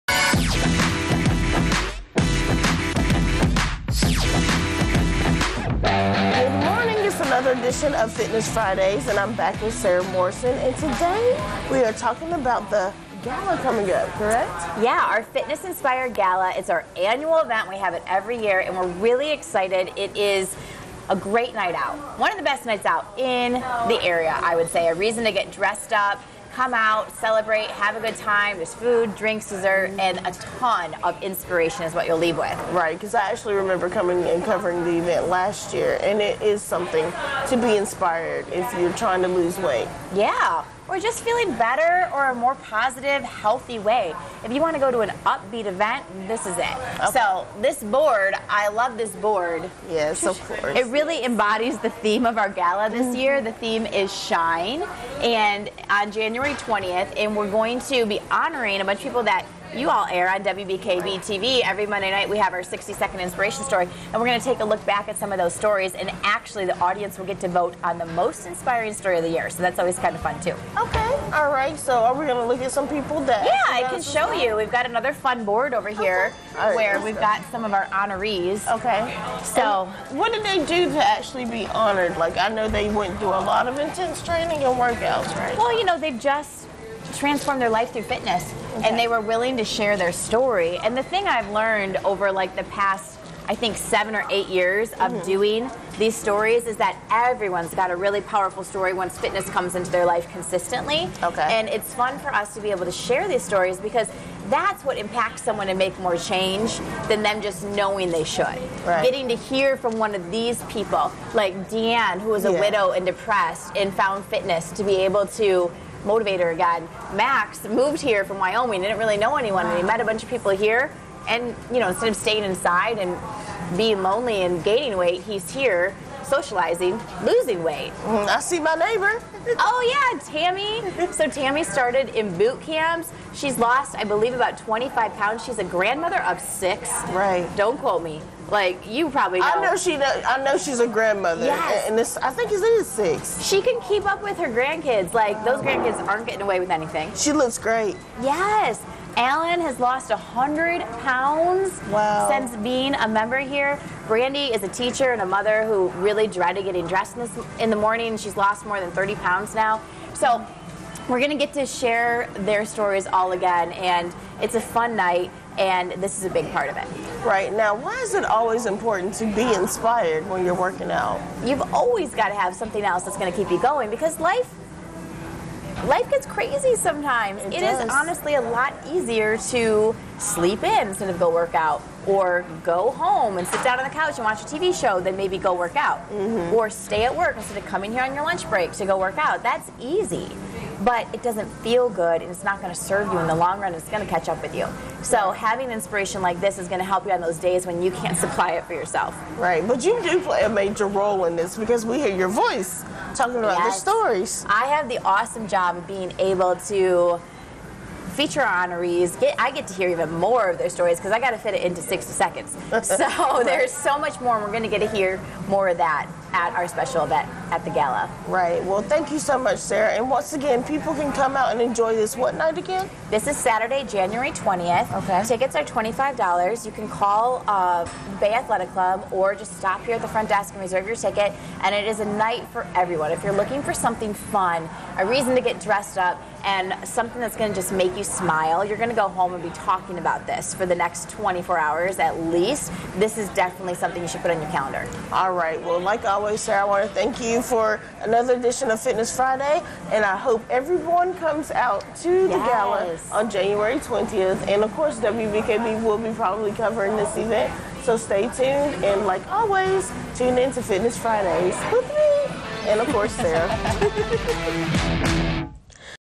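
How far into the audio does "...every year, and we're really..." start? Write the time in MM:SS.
00:18.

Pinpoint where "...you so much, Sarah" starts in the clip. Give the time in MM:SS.
03:39.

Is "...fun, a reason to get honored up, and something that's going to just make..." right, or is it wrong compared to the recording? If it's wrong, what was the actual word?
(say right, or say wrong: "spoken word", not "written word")
wrong: "dressed", not "honored".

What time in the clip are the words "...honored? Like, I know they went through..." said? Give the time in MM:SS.
01:21.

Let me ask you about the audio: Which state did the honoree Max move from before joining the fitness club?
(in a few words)
Wyoming.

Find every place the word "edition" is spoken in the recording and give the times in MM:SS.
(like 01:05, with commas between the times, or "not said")
00:07, 04:08.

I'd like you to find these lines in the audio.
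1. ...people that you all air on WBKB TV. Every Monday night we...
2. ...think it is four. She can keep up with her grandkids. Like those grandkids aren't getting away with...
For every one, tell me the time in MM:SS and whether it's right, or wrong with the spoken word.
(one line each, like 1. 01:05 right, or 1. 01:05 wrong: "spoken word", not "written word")
1. 00:59 right
2. 02:22 wrong: "six", not "four".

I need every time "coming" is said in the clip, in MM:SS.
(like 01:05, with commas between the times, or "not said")
00:13, 00:33, 03:07.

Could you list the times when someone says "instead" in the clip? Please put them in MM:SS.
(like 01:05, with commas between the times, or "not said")
02:01, 03:00, 03:07.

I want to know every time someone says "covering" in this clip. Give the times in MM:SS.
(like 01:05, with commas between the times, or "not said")
00:34, 04:16.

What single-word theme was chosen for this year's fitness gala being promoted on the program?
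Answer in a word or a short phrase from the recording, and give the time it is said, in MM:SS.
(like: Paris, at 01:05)
Shine, at 00:53.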